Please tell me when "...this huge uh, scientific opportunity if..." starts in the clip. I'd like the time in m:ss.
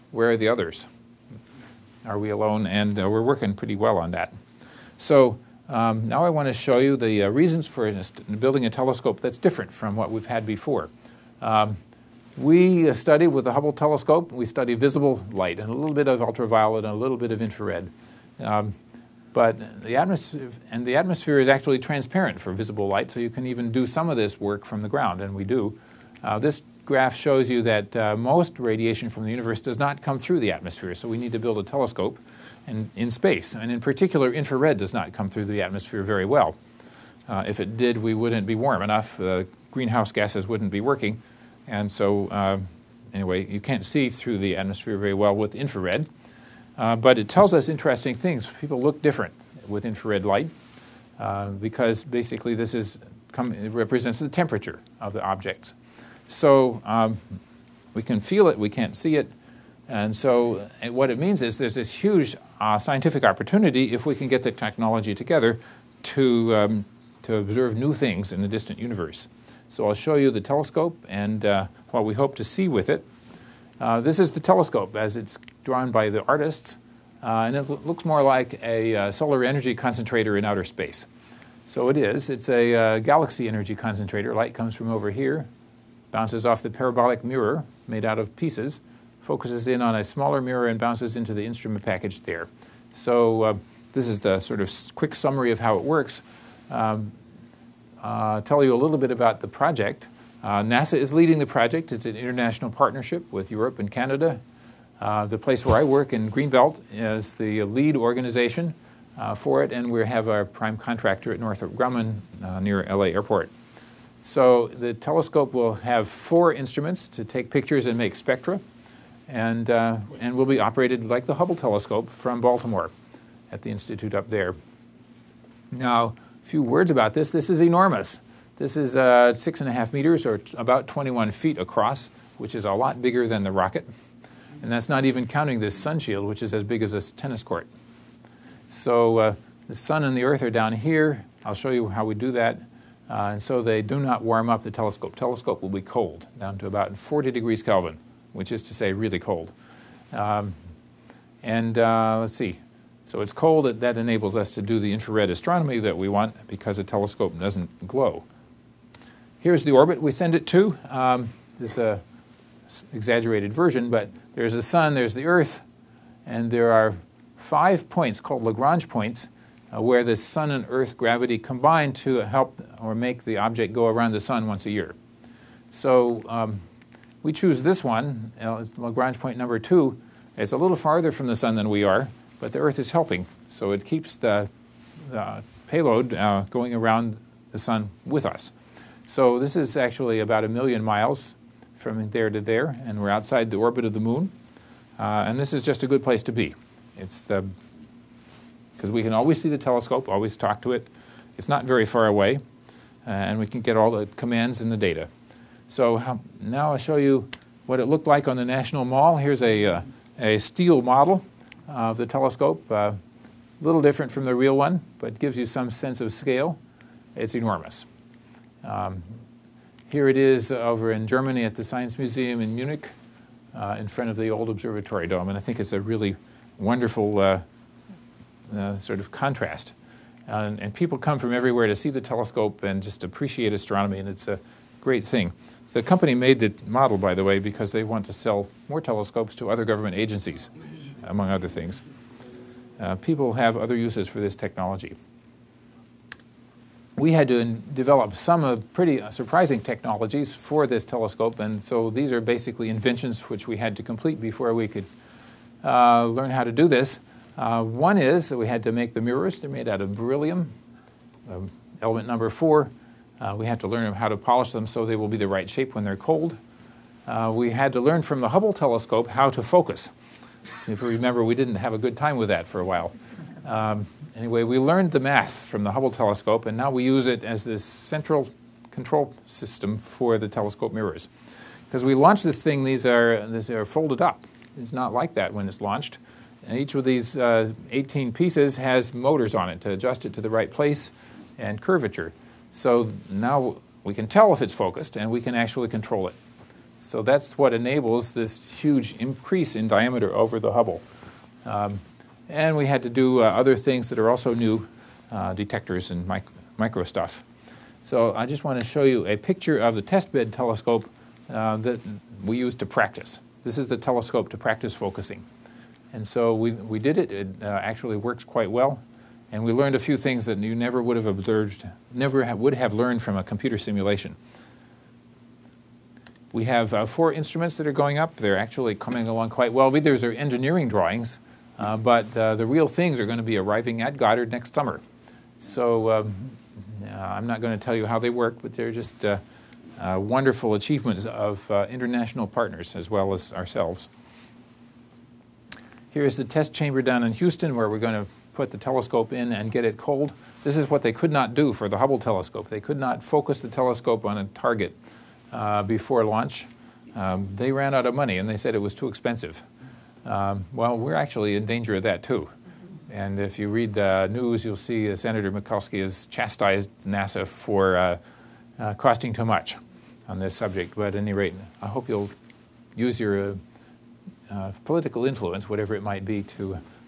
1:01.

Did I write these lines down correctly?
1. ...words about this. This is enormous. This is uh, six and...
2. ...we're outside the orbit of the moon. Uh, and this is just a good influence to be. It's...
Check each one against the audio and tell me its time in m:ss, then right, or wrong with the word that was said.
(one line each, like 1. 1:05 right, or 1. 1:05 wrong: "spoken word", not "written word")
1. 2:06 right
2. 3:13 wrong: "place", not "influence".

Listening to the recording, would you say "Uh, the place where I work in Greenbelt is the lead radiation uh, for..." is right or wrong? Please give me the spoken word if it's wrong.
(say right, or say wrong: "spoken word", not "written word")
wrong: "organization", not "radiation".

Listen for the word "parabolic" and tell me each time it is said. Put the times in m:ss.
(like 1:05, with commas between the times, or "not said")
1:26.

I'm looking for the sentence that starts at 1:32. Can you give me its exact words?
So uh, this is the sort of quick summary of how it works.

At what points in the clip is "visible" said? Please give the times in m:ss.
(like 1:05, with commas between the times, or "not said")
0:14, 0:22.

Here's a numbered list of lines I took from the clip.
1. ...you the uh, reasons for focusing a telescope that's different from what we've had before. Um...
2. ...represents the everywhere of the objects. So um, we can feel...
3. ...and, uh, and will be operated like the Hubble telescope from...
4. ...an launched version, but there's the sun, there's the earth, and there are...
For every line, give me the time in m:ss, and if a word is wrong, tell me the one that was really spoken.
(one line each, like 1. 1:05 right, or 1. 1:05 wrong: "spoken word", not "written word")
1. 0:06 wrong: "building", not "focusing"
2. 0:53 wrong: "temperature", not "everywhere"
3. 1:59 right
4. 2:41 wrong: "exaggerated", not "launched".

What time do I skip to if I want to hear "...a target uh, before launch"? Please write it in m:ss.
5:54.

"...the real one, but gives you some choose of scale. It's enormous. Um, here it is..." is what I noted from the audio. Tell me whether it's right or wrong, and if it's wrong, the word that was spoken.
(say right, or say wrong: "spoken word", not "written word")
wrong: "sense", not "choose".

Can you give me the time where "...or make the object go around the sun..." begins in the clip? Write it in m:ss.
2:52.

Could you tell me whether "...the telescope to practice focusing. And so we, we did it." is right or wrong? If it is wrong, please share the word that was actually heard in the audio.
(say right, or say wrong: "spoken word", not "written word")
right.